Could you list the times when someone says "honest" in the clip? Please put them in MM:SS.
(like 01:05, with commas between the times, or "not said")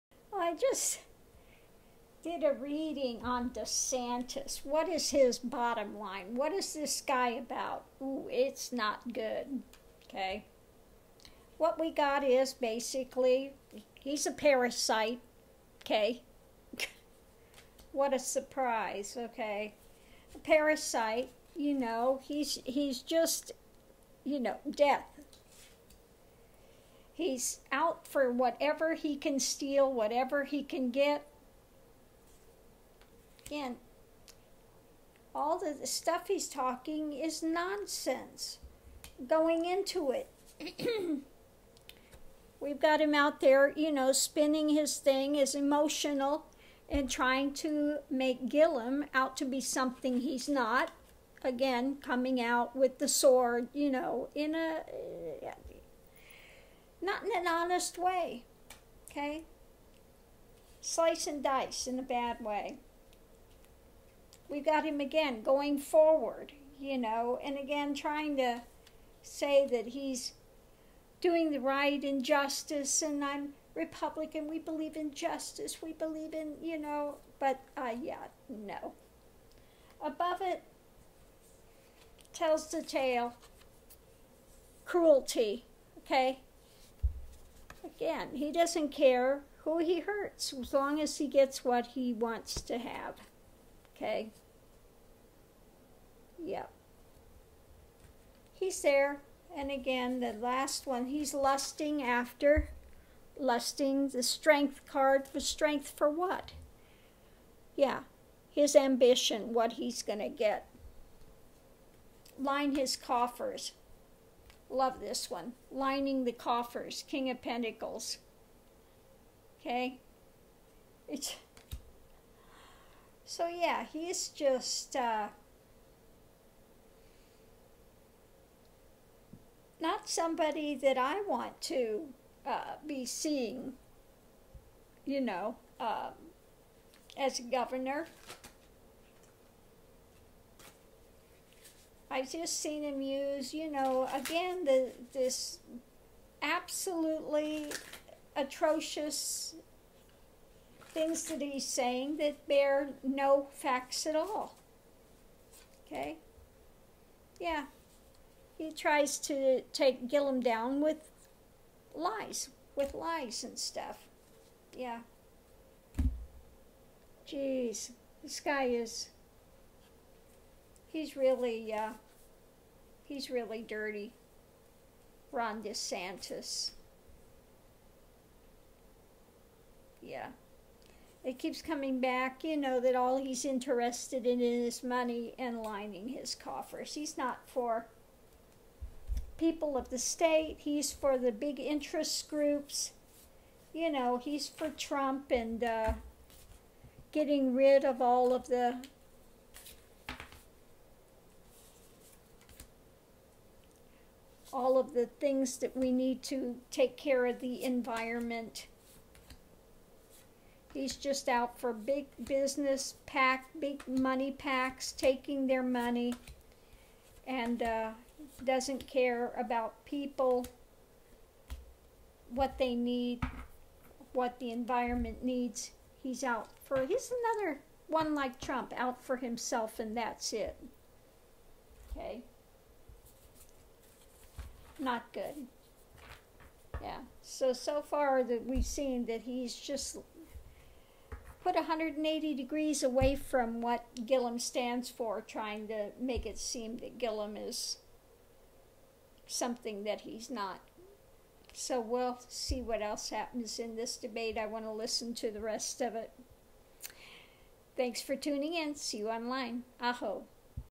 00:57.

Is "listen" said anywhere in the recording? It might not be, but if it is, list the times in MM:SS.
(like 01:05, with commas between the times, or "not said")
04:14.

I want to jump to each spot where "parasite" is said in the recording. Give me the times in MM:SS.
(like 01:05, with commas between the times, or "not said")
00:14, 00:20.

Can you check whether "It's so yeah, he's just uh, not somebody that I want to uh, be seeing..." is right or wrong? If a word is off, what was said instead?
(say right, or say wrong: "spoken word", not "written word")
right.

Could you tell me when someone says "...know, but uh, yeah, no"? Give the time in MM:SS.
01:16.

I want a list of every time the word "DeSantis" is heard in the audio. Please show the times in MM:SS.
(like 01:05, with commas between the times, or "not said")
00:03, 02:55.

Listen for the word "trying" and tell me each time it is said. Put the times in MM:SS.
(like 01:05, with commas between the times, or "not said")
00:47, 01:07, 04:05.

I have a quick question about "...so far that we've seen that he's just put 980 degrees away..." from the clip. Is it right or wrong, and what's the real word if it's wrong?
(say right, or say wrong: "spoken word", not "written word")
wrong: "180", not "980".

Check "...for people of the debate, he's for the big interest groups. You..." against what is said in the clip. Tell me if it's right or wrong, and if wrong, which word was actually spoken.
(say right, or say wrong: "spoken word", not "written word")
wrong: "state", not "debate".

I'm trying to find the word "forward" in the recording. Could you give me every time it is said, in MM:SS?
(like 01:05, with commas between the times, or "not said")
01:05.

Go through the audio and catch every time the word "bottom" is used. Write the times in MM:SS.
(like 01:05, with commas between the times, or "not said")
00:05.